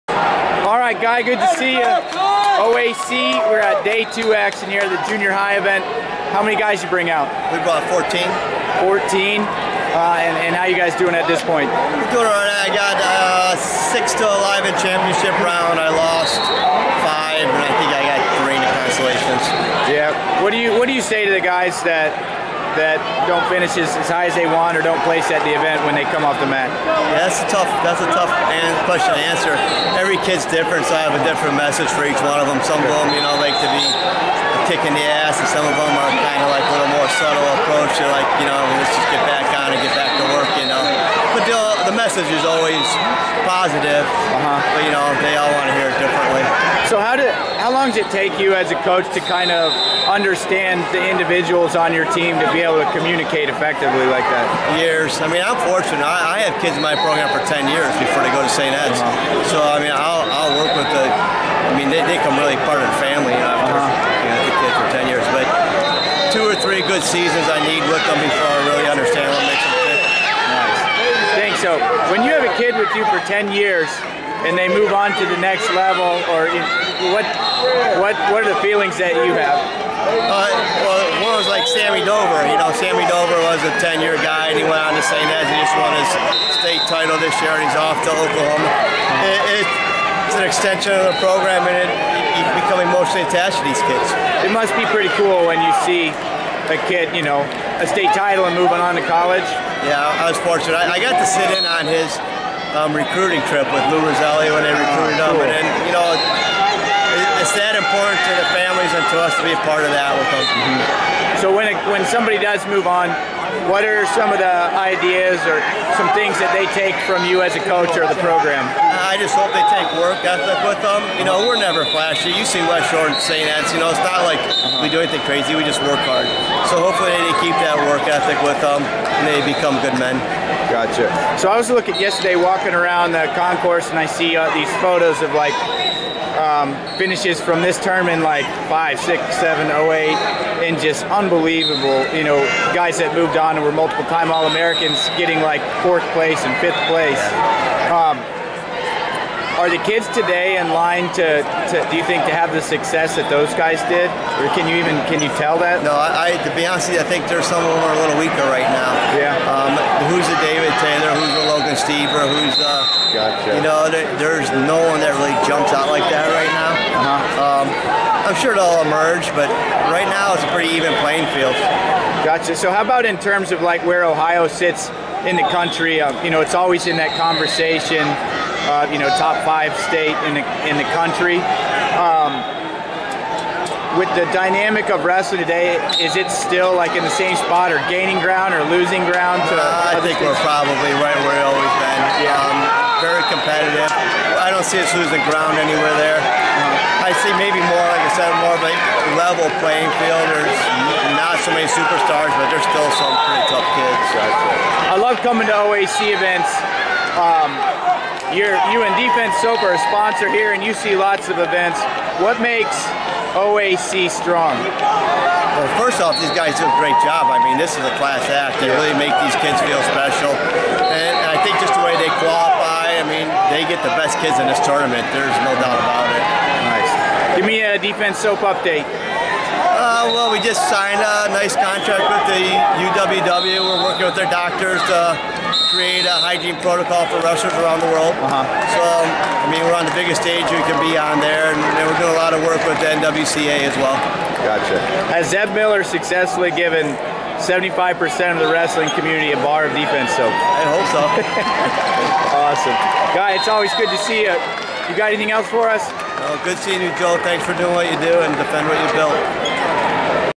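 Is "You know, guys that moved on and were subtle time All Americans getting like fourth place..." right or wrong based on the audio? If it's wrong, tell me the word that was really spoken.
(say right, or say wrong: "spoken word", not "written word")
wrong: "multiple", not "subtle".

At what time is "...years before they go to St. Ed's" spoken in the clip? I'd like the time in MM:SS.
00:57.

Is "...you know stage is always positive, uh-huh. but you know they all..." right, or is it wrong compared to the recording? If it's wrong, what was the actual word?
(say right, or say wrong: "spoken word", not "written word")
wrong: "message", not "stage".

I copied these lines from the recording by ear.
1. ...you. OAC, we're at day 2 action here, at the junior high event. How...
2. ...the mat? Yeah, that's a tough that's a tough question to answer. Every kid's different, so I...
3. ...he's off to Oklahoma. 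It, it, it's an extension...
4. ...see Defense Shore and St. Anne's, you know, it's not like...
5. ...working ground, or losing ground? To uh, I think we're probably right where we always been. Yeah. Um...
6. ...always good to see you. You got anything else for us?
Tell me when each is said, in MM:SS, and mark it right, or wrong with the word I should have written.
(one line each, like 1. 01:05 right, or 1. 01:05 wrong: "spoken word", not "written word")
1. 00:01 right
2. 00:26 right
3. 01:27 right
4. 02:02 wrong: "West", not "Defense"
5. 03:07 wrong: "gaining", not "working"
6. 04:13 right.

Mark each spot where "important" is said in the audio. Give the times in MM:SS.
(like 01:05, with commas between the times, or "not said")
01:47.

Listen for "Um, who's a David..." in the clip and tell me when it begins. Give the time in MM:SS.
02:39.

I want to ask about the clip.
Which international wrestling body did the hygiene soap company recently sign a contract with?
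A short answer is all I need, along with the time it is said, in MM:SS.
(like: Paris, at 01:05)
UWW, at 03:52.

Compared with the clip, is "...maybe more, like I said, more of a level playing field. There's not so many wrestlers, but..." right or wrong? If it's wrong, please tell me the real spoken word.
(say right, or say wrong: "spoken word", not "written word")
wrong: "superstars", not "wrestlers".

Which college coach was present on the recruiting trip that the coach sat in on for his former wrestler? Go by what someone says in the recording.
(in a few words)
Lou Rosselli.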